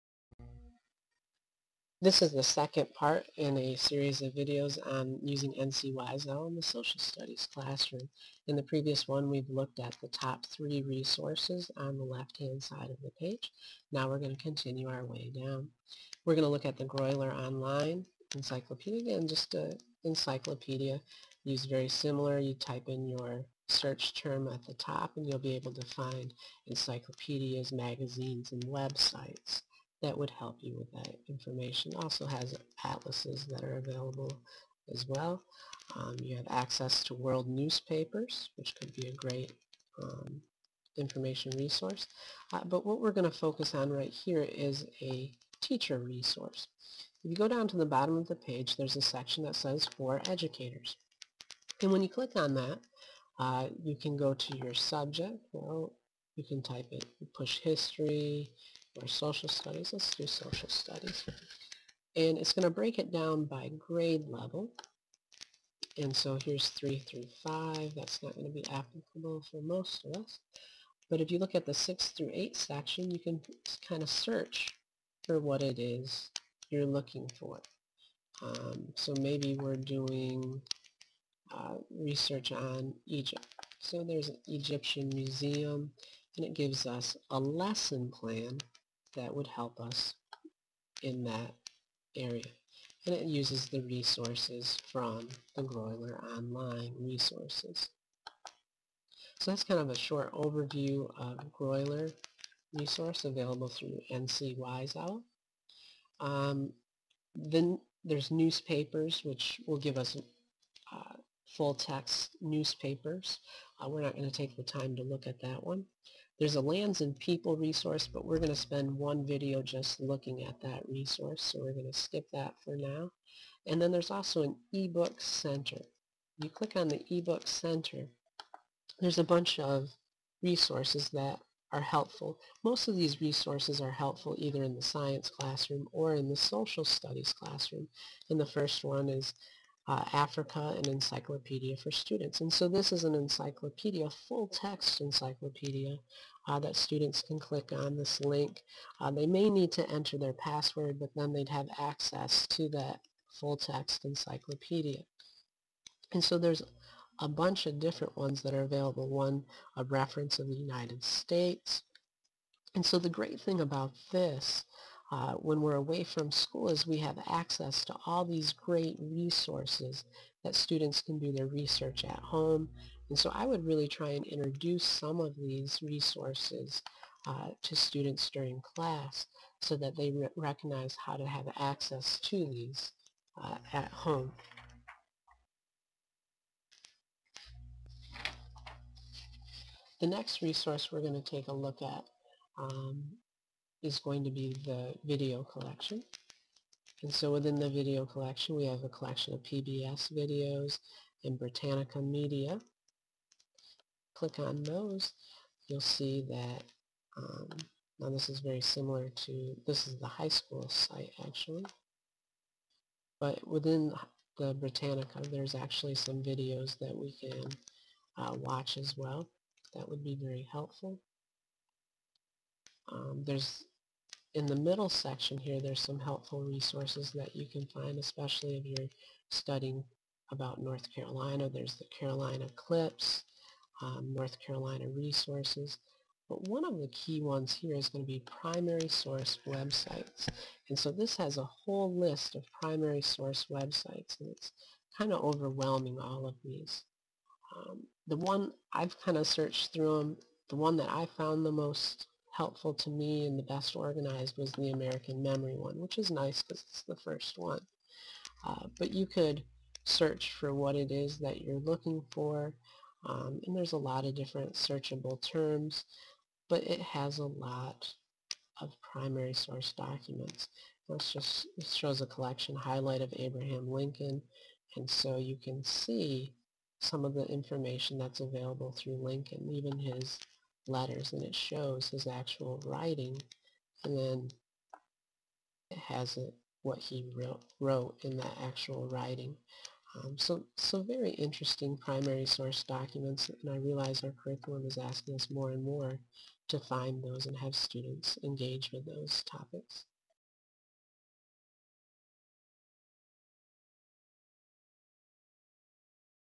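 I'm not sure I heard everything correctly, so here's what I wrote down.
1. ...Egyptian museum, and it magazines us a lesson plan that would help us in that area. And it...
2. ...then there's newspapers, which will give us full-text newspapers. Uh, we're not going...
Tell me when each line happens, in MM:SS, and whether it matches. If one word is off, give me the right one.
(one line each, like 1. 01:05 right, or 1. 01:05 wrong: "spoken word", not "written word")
1. 01:24 wrong: "gives", not "magazines"
2. 01:47 right.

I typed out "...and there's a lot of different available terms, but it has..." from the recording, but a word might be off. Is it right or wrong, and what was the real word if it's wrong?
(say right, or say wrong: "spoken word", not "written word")
wrong: "searchable", not "available".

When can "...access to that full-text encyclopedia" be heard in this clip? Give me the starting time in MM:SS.
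02:31.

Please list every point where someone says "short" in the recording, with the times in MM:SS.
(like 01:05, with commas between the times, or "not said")
01:39.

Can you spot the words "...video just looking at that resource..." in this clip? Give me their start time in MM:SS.
01:59.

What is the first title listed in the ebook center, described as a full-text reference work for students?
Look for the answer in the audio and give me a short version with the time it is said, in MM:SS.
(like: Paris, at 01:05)
Africa, at 02:20.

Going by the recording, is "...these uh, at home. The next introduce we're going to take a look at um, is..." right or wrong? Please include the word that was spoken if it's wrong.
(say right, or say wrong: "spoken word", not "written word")
wrong: "resource", not "introduce".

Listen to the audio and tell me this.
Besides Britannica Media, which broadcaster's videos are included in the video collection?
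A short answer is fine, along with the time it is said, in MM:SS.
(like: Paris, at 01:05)
PBS, at 03:19.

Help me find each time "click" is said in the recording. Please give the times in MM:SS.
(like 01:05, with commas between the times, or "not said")
00:52, 02:06, 02:27, 03:24.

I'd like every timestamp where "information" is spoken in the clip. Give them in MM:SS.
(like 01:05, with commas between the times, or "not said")
00:31, 00:40, 04:37.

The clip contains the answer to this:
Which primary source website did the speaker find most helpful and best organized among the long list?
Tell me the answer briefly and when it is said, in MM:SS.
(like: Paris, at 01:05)
American Memory, at 04:14.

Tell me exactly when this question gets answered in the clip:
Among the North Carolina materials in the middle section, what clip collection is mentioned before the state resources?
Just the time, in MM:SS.
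03:51.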